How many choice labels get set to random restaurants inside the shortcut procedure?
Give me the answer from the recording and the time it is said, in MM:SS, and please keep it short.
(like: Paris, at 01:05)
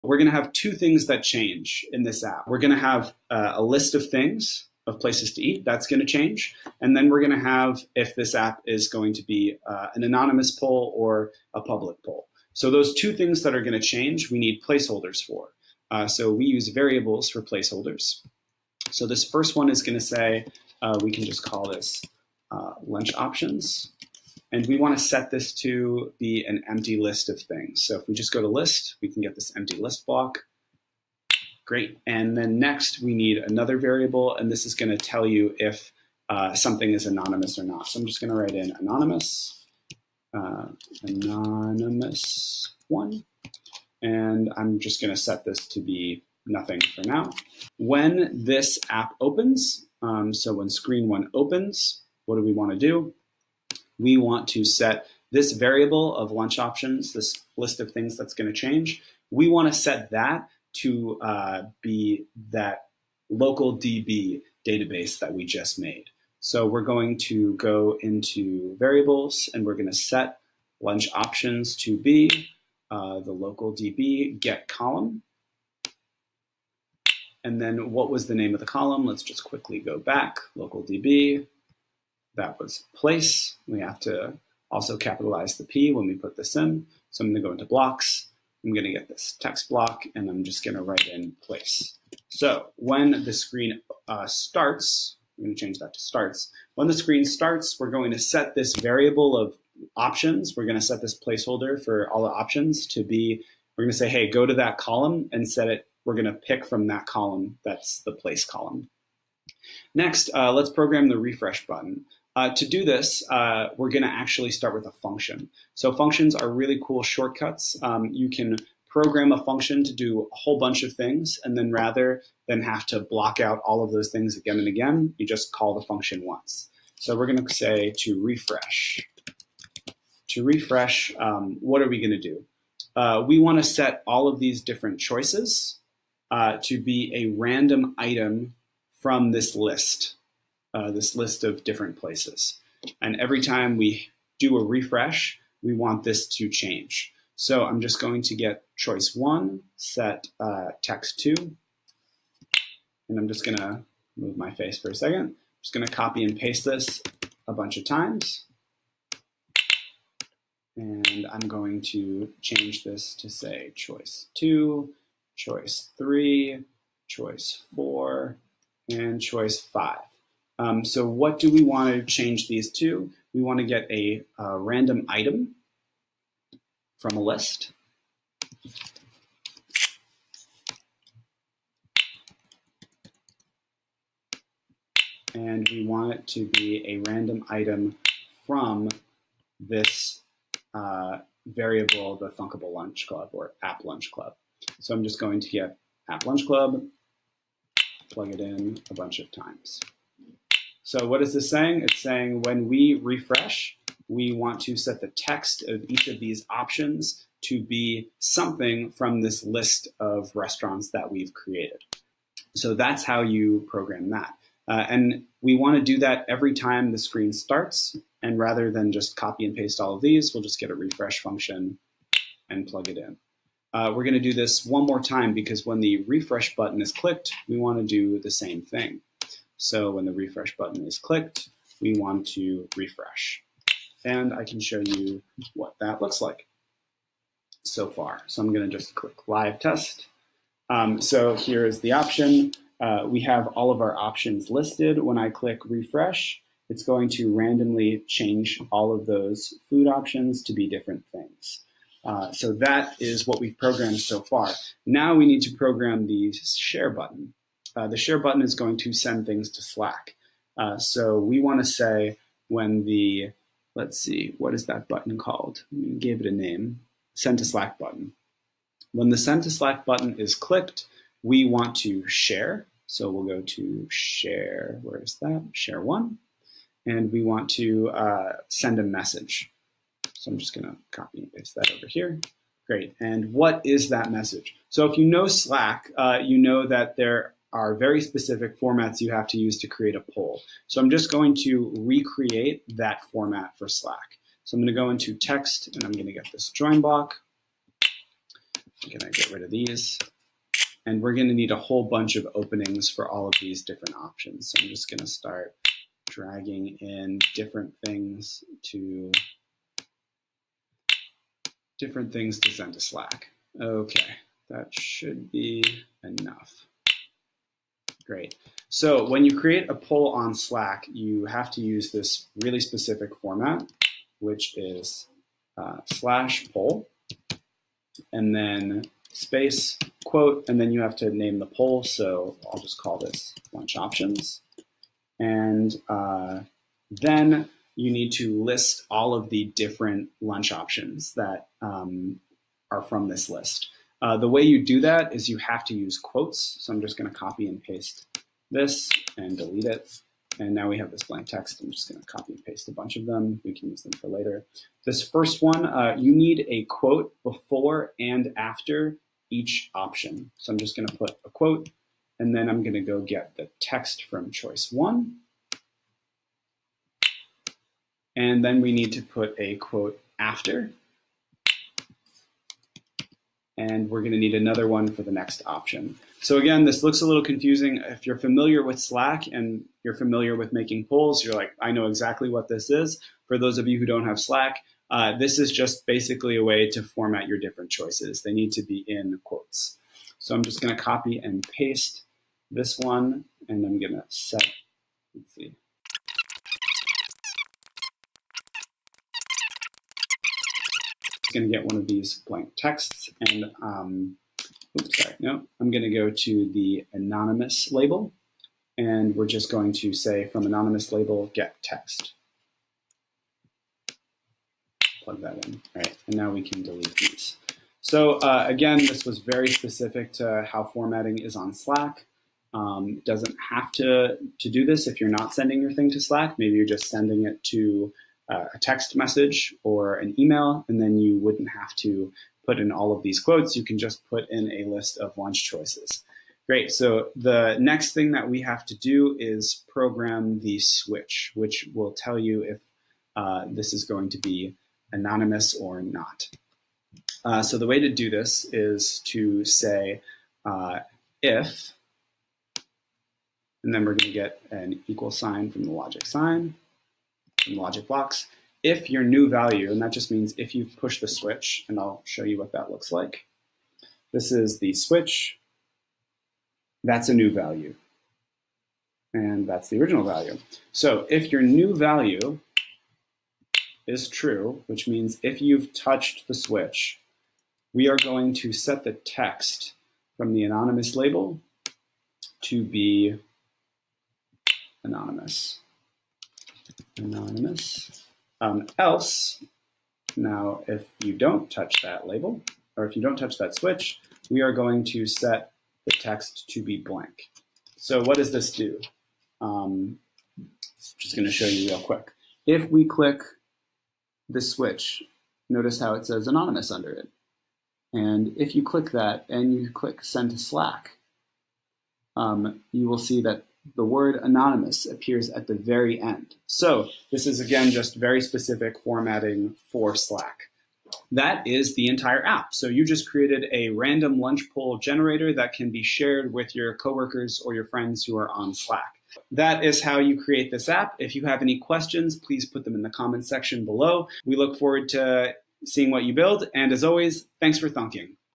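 5, at 02:49.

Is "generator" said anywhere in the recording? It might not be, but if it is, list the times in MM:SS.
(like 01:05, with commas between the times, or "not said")
08:44.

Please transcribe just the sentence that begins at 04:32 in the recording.
So we'll go to share, where is that?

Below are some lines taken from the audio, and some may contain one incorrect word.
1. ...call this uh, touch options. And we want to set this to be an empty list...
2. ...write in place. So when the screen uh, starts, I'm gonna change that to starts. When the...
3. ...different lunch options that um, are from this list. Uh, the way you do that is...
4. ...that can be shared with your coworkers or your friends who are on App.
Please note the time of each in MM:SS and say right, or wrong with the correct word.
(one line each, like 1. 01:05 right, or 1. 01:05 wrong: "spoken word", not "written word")
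1. 00:21 wrong: "lunch", not "touch"
2. 01:30 right
3. 05:39 right
4. 08:45 wrong: "Slack", not "App".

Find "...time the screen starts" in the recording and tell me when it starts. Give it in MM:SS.
03:36.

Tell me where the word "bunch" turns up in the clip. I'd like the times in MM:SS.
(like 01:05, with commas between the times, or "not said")
02:00, 02:37, 03:18, 05:01, 05:52.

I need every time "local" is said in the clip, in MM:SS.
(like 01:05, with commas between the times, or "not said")
01:03, 01:13, 01:20.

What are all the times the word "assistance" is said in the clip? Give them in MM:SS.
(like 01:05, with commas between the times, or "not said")
not said.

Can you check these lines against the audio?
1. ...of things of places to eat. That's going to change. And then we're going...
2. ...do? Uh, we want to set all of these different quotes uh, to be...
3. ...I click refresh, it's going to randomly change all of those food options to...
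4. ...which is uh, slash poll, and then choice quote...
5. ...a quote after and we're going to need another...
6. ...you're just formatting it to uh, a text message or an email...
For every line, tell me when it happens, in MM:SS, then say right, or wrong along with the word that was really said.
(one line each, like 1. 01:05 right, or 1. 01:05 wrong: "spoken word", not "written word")
1. 00:03 right
2. 02:12 wrong: "choices", not "quotes"
3. 04:05 right
4. 05:24 wrong: "space", not "choice"
5. 06:09 right
6. 07:06 wrong: "sending", not "formatting".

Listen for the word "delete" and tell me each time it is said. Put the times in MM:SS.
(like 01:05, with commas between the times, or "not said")
05:49, 06:56.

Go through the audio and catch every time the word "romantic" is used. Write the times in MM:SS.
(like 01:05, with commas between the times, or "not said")
not said.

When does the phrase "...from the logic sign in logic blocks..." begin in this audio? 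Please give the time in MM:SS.
07:35.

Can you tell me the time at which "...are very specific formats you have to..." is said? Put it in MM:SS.
04:47.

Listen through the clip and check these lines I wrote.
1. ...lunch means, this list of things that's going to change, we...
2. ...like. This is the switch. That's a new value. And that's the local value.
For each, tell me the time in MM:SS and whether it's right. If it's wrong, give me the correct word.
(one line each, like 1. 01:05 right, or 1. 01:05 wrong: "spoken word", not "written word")
1. 00:56 wrong: "options", not "means"
2. 07:42 wrong: "original", not "local".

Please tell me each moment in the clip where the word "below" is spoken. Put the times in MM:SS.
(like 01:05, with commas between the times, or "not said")
08:53.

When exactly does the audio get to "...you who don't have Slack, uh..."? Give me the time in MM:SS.
06:23.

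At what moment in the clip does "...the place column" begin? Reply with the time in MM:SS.
01:48.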